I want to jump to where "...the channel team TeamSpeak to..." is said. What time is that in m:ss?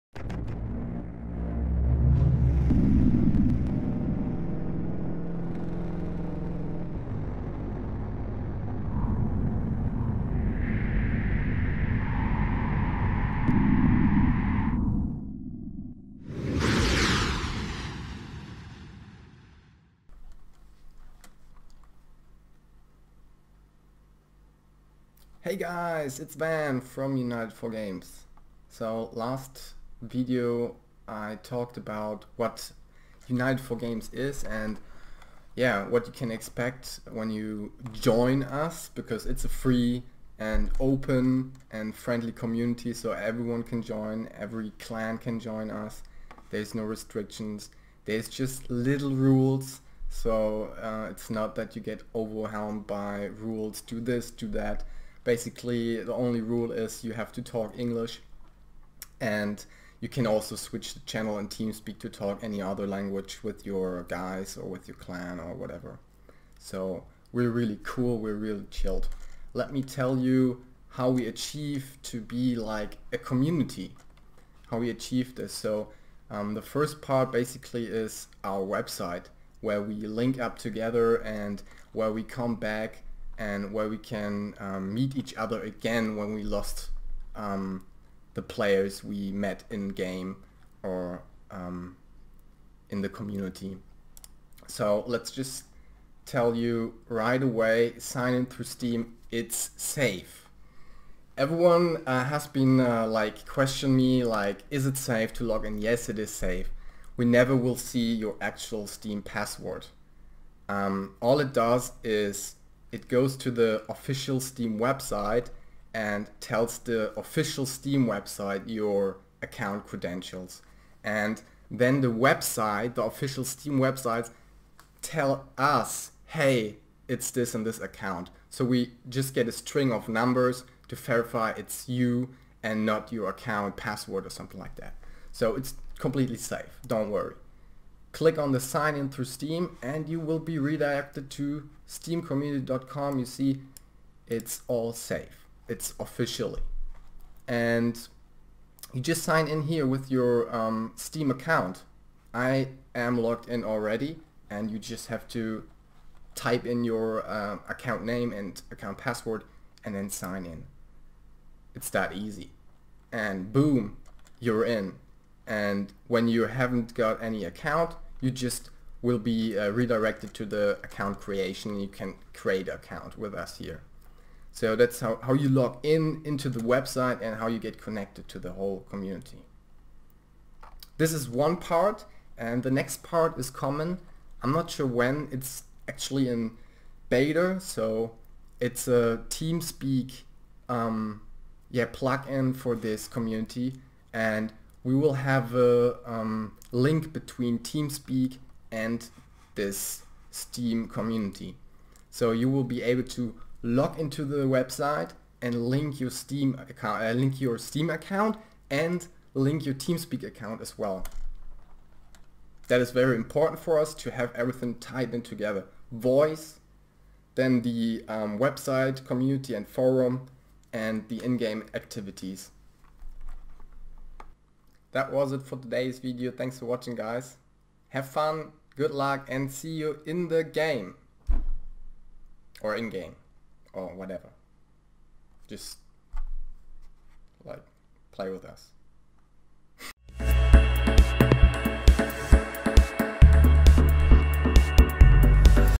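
1:00.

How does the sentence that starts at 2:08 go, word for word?
So we just get a string of numbers to verify it's you and not your account password or something like that.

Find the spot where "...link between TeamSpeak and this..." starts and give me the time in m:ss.
3:16.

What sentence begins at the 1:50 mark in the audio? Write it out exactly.
Um, all it does is it goes to the official Steam website and tells the official Steam website your account credentials.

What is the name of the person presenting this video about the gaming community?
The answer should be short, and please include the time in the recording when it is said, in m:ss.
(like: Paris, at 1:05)
Ben, at 0:26.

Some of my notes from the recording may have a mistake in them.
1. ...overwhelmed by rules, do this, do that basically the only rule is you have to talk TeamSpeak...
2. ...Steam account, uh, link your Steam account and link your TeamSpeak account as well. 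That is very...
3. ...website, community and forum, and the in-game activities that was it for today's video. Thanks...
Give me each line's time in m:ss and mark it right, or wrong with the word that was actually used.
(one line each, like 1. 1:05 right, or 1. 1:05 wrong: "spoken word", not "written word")
1. 0:52 wrong: "English", not "TeamSpeak"
2. 3:26 right
3. 3:38 right.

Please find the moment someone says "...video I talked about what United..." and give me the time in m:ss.
0:30.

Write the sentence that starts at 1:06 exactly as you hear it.
So we're really cool, we're really chilled.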